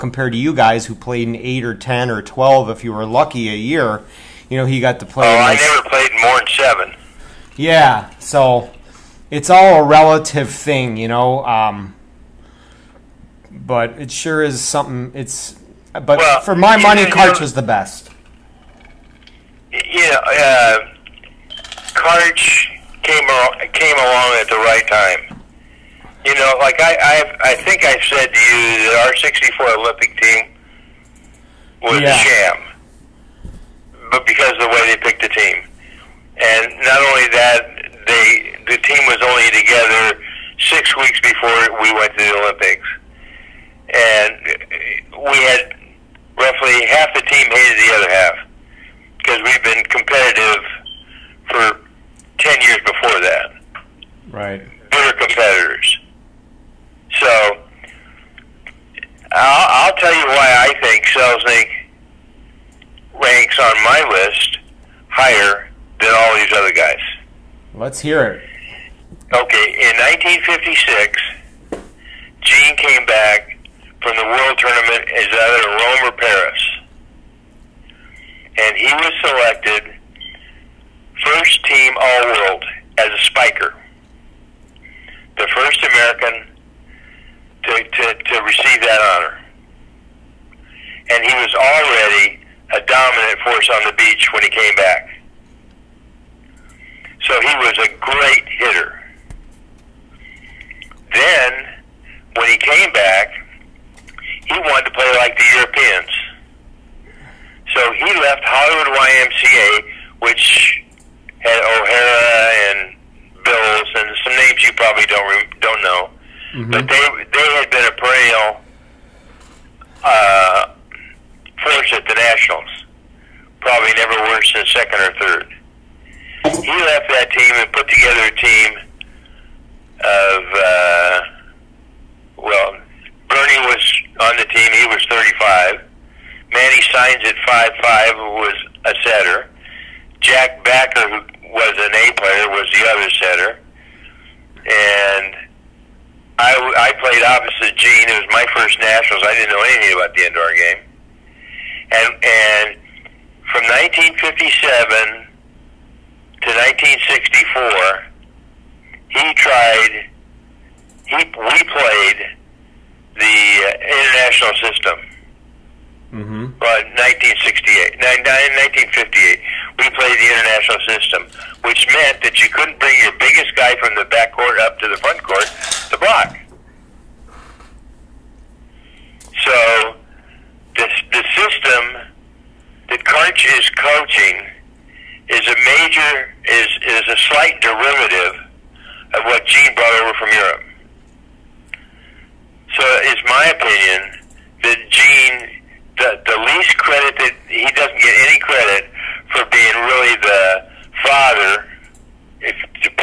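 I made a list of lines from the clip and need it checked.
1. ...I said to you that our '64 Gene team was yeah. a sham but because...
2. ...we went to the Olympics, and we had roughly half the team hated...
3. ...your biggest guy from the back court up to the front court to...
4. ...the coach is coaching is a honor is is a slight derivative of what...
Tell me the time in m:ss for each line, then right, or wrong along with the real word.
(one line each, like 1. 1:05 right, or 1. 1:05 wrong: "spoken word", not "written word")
1. 0:27 wrong: "Olympic", not "Gene"
2. 0:41 right
3. 2:52 right
4. 3:02 wrong: "major", not "honor".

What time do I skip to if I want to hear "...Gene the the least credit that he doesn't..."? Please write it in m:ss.
3:14.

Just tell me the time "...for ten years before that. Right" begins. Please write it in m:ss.
0:51.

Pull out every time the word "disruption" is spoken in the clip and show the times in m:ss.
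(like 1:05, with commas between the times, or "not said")
not said.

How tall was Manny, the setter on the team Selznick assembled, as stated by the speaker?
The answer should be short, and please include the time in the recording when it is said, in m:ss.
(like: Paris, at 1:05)
5'5, at 2:17.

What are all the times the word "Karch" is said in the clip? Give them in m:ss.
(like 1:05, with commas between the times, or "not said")
0:17, 0:21.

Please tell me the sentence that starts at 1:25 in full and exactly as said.
The first American to, to, to receive that honor.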